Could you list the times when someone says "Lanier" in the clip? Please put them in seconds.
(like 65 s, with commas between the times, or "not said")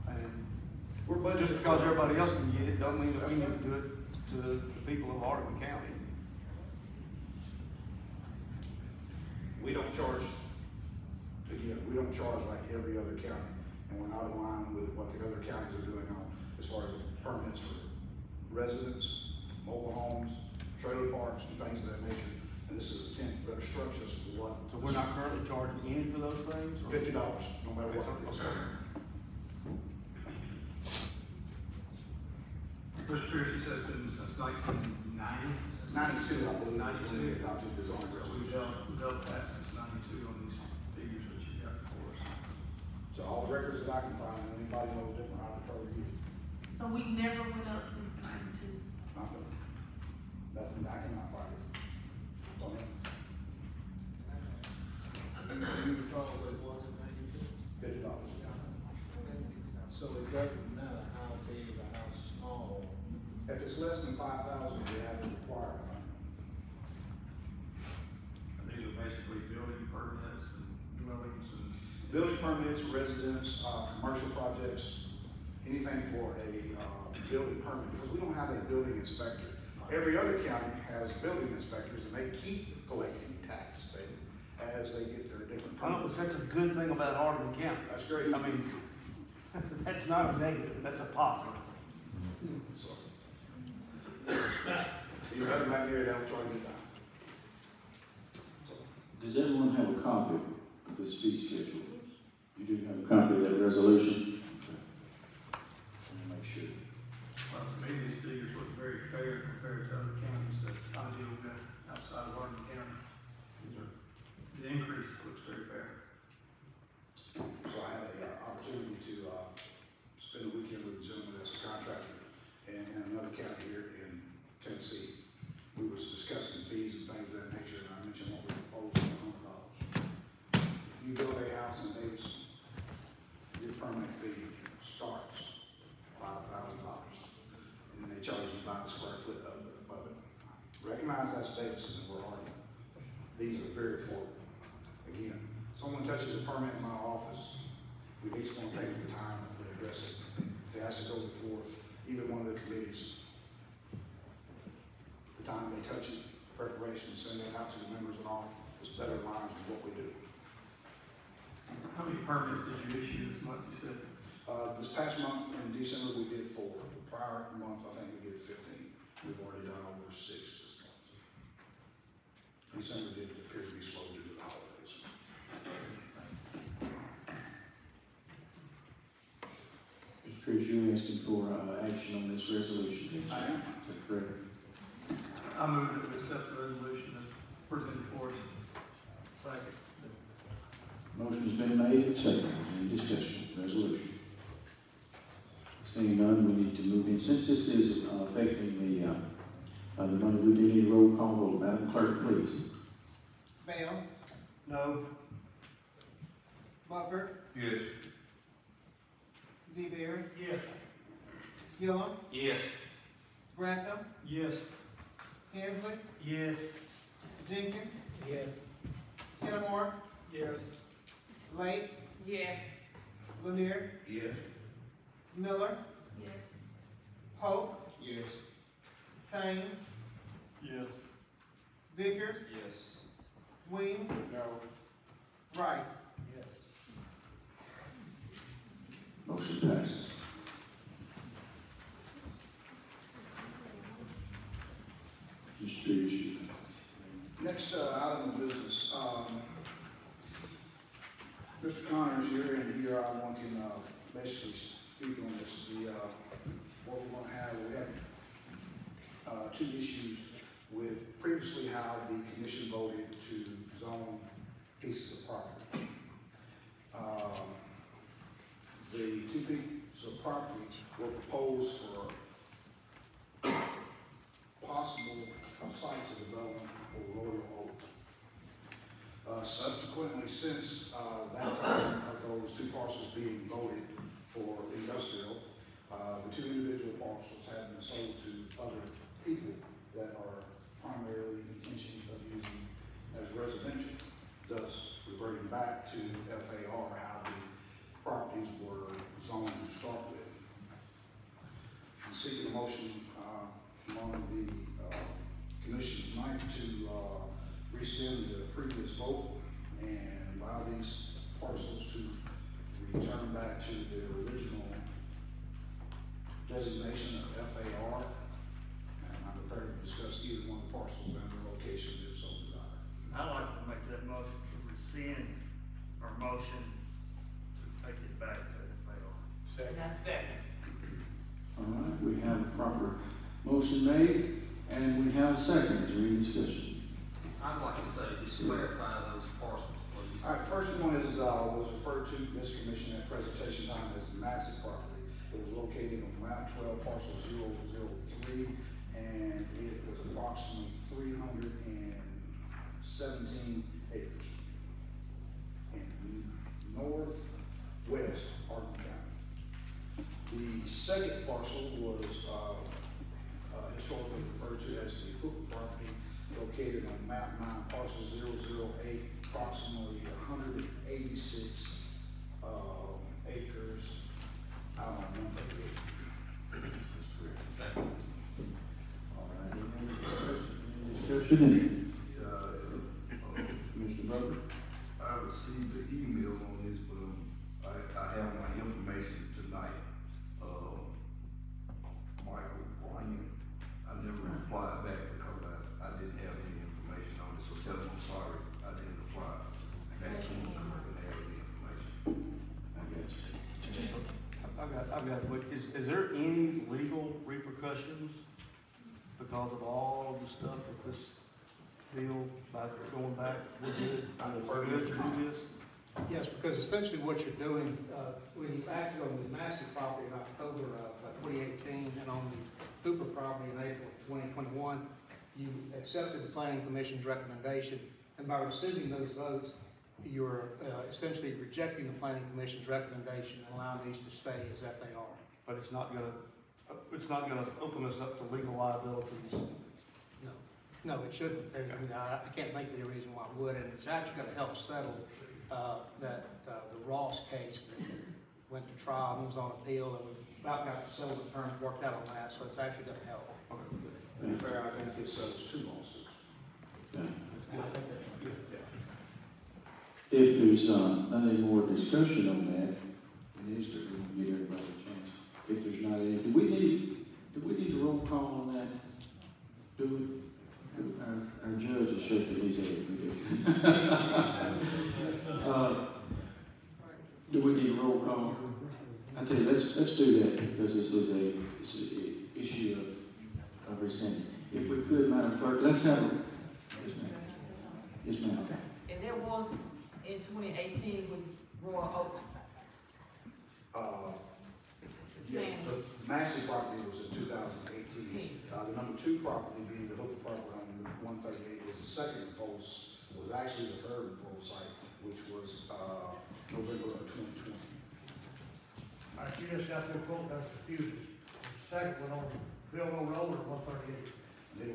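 223 s.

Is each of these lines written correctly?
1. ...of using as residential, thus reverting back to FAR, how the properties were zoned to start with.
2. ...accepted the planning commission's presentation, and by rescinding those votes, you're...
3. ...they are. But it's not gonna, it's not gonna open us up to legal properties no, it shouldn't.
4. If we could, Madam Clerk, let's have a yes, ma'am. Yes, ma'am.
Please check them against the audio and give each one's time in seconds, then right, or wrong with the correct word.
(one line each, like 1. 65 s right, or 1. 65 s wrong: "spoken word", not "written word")
1. 292 s right
2. 425 s wrong: "recommendation", not "presentation"
3. 434 s wrong: "liabilities", not "properties"
4. 484 s right.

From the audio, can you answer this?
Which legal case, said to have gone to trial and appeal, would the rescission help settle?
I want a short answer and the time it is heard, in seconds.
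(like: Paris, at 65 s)
The Ross case, at 446 s.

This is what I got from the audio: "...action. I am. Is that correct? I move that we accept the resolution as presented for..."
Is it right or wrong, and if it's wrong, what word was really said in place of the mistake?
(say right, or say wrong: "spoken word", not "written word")
wrong: "resolution", not "action".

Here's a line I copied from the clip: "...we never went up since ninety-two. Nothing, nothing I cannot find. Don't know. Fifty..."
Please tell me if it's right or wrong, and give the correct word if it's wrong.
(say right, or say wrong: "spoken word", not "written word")
right.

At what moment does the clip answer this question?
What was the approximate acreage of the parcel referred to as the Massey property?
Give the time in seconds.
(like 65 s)
350 s.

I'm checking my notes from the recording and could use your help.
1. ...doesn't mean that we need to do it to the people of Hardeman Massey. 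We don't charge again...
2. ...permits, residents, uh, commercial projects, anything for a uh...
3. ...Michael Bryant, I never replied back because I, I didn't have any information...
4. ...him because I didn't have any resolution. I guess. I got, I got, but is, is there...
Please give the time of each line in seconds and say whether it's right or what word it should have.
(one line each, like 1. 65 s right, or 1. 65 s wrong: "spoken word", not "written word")
1. 2 s wrong: "County", not "Massey"
2. 72 s right
3. 392 s right
4. 400 s wrong: "information", not "resolution".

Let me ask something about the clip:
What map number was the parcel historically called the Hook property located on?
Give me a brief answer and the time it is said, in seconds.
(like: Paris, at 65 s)
Map 9, at 367 s.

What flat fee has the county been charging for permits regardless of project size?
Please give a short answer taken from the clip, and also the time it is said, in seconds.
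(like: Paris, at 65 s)
$50, at 26 s.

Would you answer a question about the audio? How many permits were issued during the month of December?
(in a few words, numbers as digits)
4.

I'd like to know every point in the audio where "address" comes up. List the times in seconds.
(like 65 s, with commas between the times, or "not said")
149 s.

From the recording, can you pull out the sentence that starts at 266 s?
Um, the two pieces of property were proposed for possible sites of development for Royal Oak.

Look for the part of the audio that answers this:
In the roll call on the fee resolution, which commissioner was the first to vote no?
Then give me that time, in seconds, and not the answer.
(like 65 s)
203 s.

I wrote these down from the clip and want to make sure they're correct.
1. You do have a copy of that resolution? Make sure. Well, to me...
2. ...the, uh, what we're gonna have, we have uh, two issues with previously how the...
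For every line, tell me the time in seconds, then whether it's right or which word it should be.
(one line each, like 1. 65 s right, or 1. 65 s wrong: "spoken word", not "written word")
1. 102 s right
2. 255 s right.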